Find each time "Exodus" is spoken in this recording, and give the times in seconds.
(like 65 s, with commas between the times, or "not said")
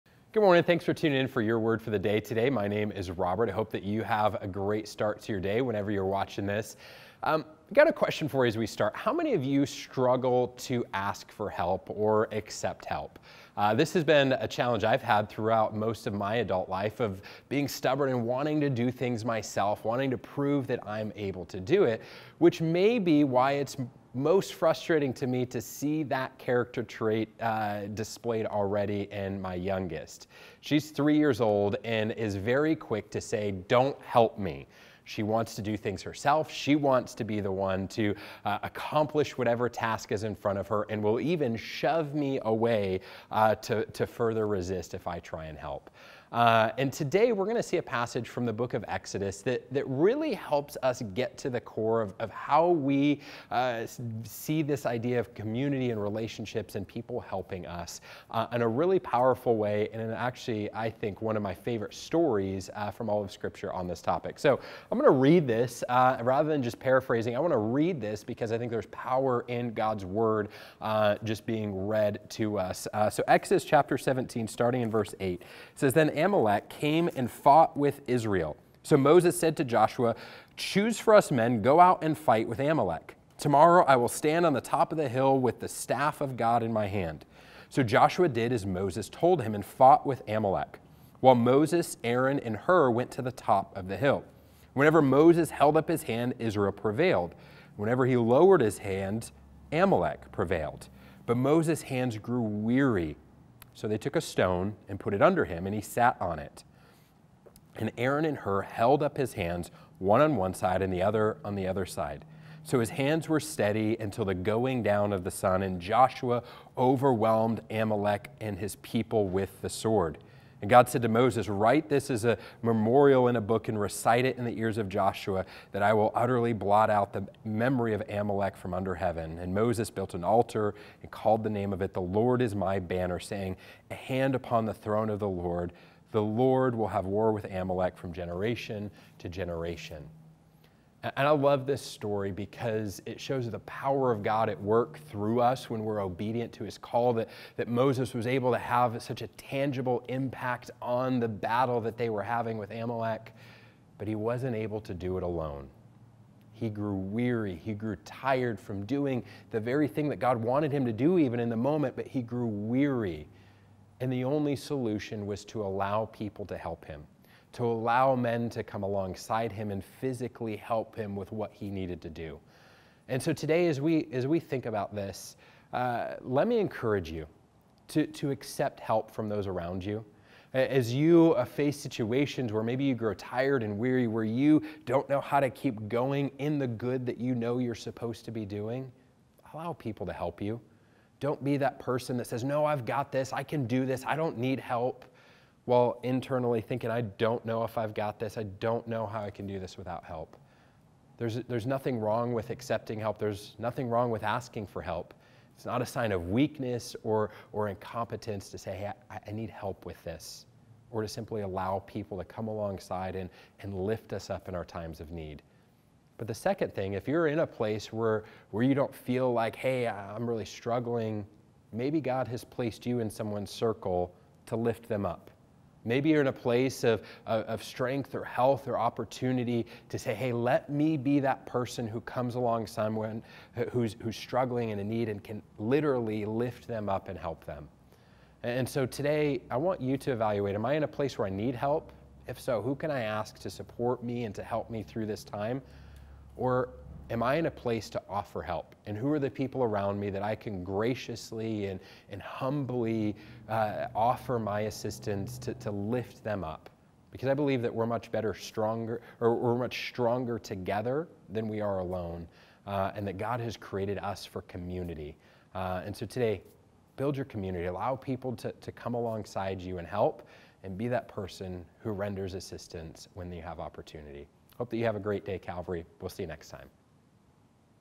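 48 s, 73 s.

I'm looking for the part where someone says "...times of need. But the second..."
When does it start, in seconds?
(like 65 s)
214 s.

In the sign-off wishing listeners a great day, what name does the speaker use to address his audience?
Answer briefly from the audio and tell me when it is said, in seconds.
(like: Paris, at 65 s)
Calvary, at 275 s.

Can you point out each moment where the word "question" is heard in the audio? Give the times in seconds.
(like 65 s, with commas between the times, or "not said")
7 s.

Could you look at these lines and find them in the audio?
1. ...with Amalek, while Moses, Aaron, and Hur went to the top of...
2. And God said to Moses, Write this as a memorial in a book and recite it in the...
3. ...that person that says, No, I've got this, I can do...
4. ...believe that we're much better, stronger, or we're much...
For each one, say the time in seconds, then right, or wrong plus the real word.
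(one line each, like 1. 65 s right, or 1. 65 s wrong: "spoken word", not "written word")
1. 90 s right
2. 120 s right
3. 191 s right
4. 257 s right.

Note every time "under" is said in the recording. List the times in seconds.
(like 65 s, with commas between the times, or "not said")
105 s, 128 s.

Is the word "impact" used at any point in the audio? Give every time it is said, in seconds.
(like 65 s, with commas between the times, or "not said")
150 s.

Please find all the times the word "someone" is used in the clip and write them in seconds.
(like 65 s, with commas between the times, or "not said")
223 s, 232 s.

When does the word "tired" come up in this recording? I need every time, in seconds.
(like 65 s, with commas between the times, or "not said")
158 s, 183 s.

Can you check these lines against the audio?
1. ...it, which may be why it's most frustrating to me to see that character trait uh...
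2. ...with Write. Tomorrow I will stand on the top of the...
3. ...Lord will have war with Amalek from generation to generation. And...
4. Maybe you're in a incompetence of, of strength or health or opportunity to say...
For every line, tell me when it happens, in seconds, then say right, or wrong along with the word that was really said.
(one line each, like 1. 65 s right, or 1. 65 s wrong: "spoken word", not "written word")
1. 21 s right
2. 82 s wrong: "Amalek", not "Write"
3. 136 s right
4. 225 s wrong: "place", not "incompetence".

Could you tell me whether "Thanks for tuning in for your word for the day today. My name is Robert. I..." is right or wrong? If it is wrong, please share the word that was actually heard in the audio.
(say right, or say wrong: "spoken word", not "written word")
right.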